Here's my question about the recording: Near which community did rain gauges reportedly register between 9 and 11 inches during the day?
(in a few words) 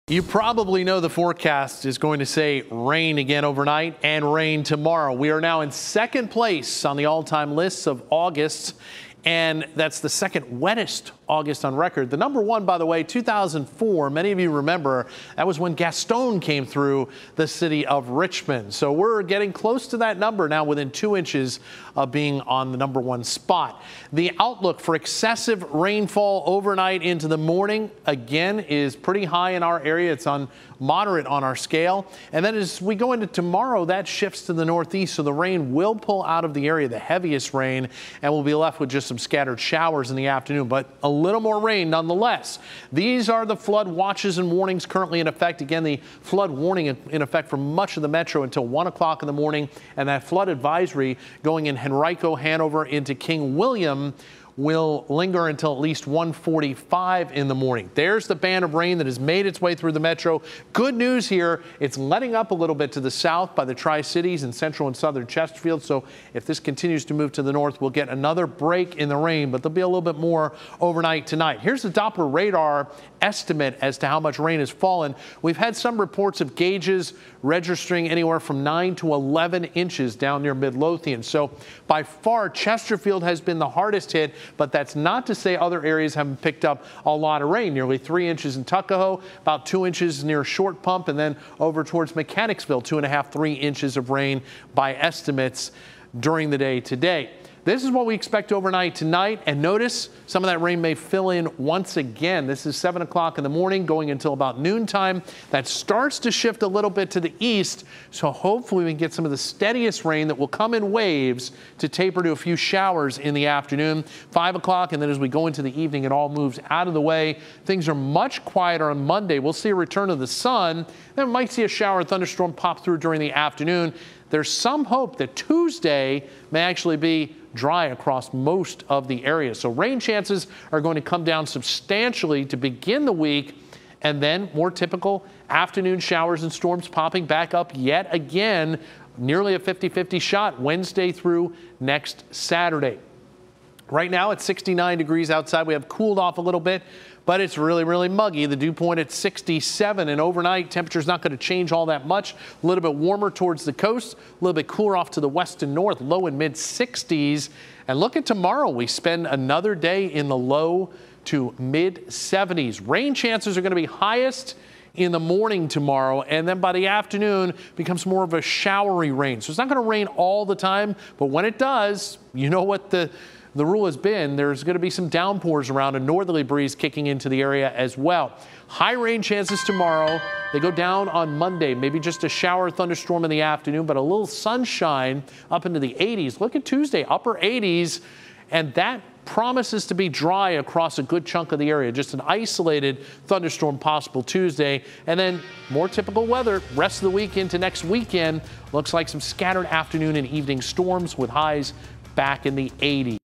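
Midlothian.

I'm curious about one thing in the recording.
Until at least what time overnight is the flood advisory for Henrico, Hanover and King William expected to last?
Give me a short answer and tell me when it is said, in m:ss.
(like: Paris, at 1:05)
1:45, at 0:56.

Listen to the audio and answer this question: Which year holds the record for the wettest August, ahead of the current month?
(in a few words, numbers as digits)
2004.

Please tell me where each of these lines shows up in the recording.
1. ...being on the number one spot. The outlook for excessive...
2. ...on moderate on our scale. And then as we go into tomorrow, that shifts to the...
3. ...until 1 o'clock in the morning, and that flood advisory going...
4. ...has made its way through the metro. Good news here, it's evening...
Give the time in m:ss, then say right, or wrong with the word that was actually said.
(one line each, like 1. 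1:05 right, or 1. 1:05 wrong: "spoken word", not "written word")
1. 0:22 right
2. 0:30 right
3. 0:48 right
4. 0:59 wrong: "letting", not "evening".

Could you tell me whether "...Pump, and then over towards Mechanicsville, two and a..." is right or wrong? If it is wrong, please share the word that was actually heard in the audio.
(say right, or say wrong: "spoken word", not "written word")
right.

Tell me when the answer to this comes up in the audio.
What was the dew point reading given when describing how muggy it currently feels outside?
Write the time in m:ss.
2:29.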